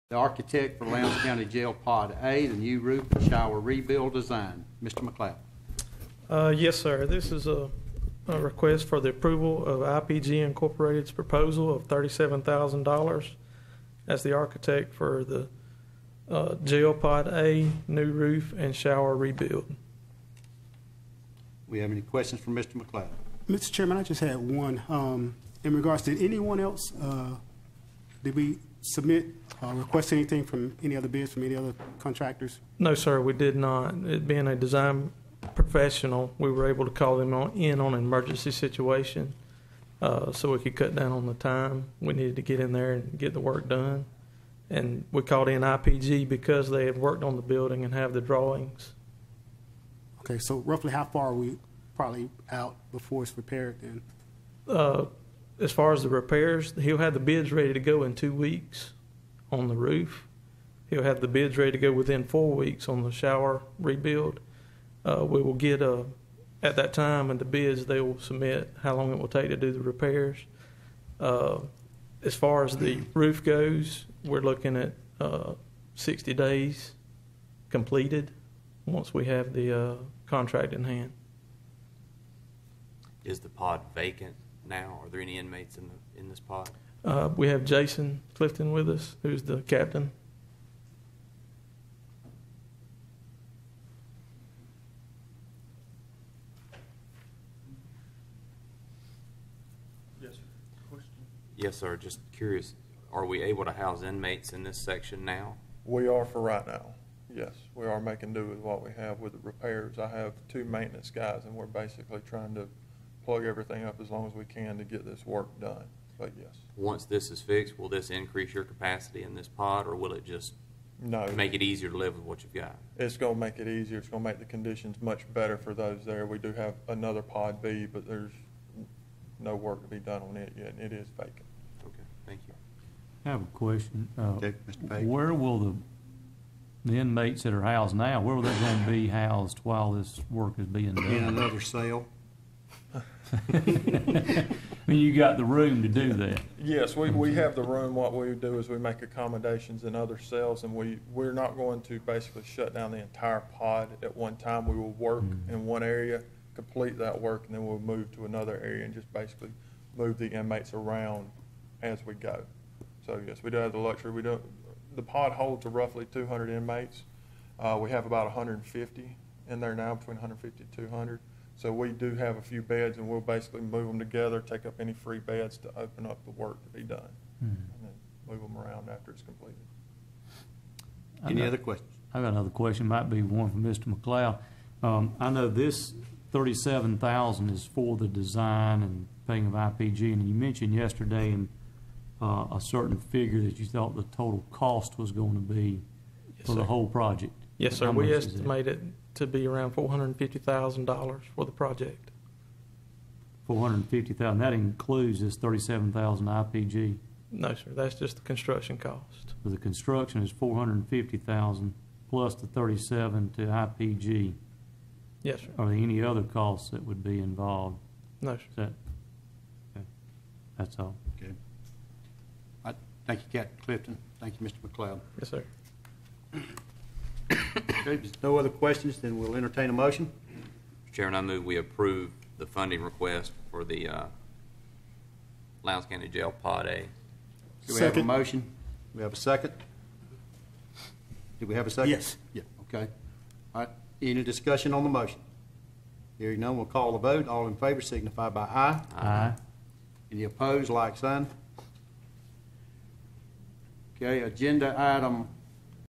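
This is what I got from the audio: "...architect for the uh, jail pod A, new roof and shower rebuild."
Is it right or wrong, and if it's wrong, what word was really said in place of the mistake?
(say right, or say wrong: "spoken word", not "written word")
right.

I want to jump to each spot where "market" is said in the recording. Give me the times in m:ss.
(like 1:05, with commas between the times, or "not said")
not said.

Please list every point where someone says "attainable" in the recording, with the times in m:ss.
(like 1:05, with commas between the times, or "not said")
not said.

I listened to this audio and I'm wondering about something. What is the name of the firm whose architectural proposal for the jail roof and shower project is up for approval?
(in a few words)
IPG Incorporated.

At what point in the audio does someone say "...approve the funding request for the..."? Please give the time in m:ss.
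3:51.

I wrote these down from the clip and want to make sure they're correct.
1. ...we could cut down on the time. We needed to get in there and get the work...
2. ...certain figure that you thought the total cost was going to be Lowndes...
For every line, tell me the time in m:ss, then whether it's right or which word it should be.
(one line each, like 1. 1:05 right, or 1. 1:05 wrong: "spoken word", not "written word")
1. 0:40 right
2. 3:12 wrong: "Yes", not "Lowndes".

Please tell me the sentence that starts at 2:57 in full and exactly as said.
and then move them around after it's completed.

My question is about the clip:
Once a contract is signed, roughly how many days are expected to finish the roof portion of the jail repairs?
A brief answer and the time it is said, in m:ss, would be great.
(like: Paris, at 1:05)
60 days, at 1:15.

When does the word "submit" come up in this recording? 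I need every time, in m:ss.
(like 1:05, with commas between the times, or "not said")
0:28, 1:08.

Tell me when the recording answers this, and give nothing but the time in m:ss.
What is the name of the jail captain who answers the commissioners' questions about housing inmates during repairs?
1:27.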